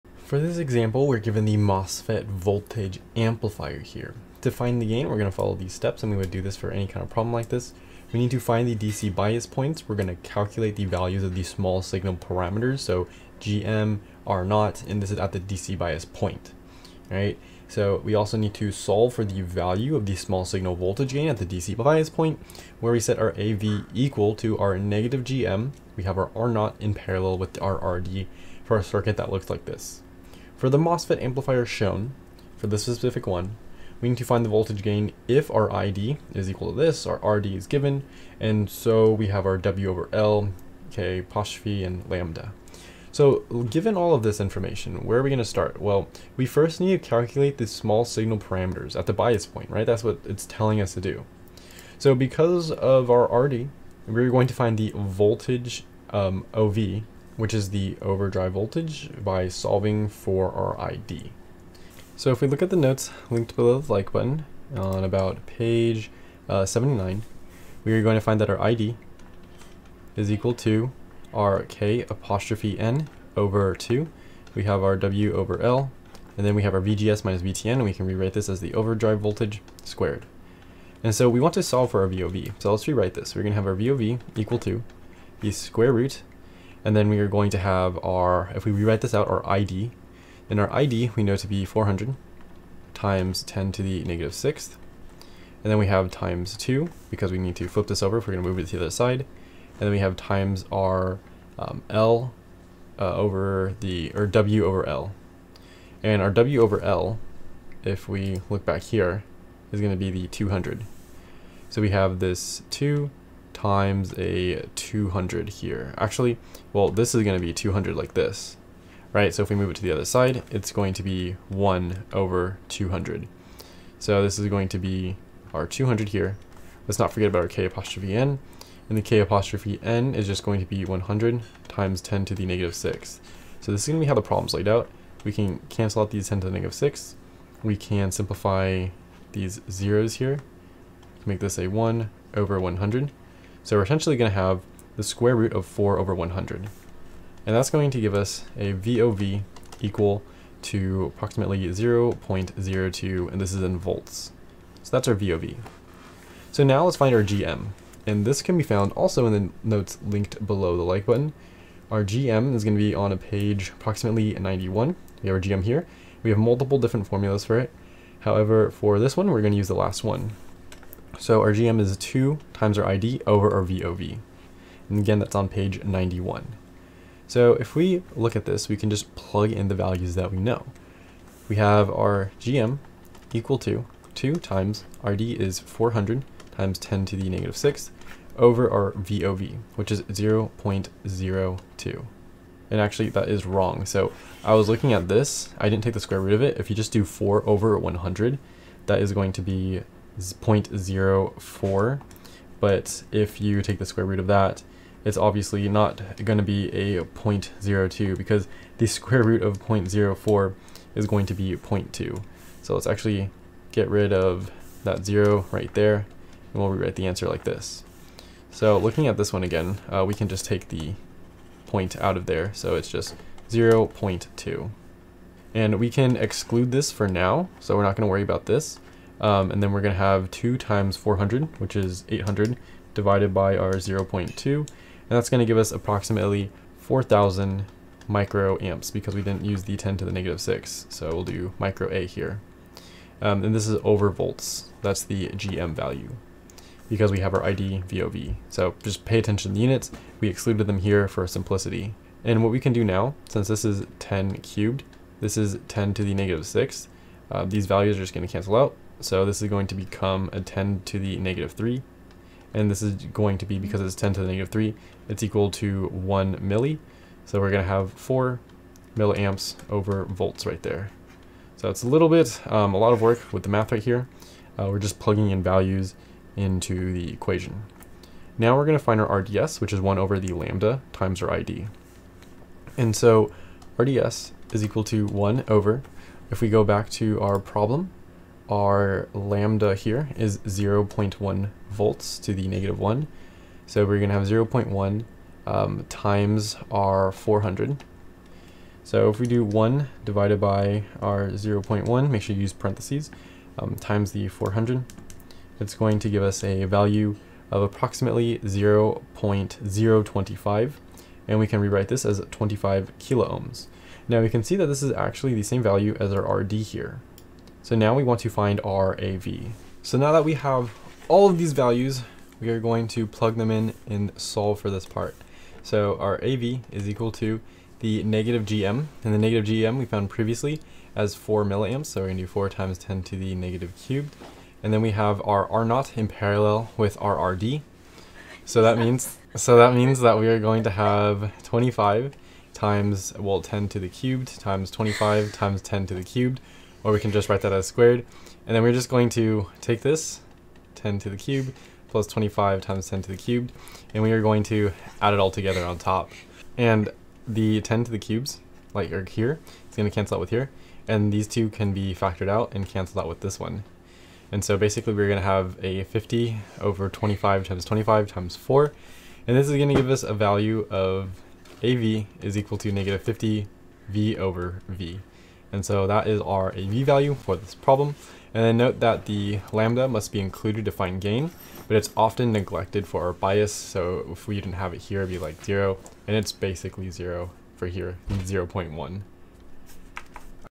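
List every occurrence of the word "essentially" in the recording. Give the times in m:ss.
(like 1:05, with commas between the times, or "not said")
2:23.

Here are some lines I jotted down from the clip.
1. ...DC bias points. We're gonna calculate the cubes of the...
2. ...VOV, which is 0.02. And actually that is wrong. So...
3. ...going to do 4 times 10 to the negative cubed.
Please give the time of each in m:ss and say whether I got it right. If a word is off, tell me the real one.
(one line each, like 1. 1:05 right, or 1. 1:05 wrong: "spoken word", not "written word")
1. 0:08 wrong: "values", not "cubes"
2. 3:08 right
3. 5:32 right.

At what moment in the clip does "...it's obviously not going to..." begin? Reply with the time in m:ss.
3:25.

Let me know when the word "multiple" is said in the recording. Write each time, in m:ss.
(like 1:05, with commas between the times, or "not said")
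2:46.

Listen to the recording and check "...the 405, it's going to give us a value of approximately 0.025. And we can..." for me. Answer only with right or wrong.
wrong.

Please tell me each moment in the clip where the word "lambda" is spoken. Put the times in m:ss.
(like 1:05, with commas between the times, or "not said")
0:42, 4:40, 4:49, 6:19.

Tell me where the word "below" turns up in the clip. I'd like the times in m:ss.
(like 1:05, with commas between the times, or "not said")
1:03, 2:40.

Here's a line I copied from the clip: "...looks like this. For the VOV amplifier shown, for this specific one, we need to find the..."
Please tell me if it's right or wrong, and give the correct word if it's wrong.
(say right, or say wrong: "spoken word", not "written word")
wrong: "MOSFET", not "VOV".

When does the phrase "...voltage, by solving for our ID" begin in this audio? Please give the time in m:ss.
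0:58.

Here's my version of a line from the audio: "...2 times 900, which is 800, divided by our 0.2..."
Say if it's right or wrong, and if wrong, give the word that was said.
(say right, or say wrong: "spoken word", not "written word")
wrong: "400", not "900".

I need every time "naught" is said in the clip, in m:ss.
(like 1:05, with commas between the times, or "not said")
0:14.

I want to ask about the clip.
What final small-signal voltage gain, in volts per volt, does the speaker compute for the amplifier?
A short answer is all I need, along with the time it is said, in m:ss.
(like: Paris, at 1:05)
-50, at 6:12.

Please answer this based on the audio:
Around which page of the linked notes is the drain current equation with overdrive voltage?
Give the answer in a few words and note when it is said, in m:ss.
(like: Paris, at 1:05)
79, at 1:06.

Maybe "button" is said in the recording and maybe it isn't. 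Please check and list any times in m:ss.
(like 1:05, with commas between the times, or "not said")
1:04, 2:41.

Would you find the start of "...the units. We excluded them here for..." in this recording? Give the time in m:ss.
4:09.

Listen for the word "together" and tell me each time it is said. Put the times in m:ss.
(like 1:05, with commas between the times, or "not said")
5:55.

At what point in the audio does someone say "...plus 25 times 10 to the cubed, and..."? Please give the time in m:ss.
5:51.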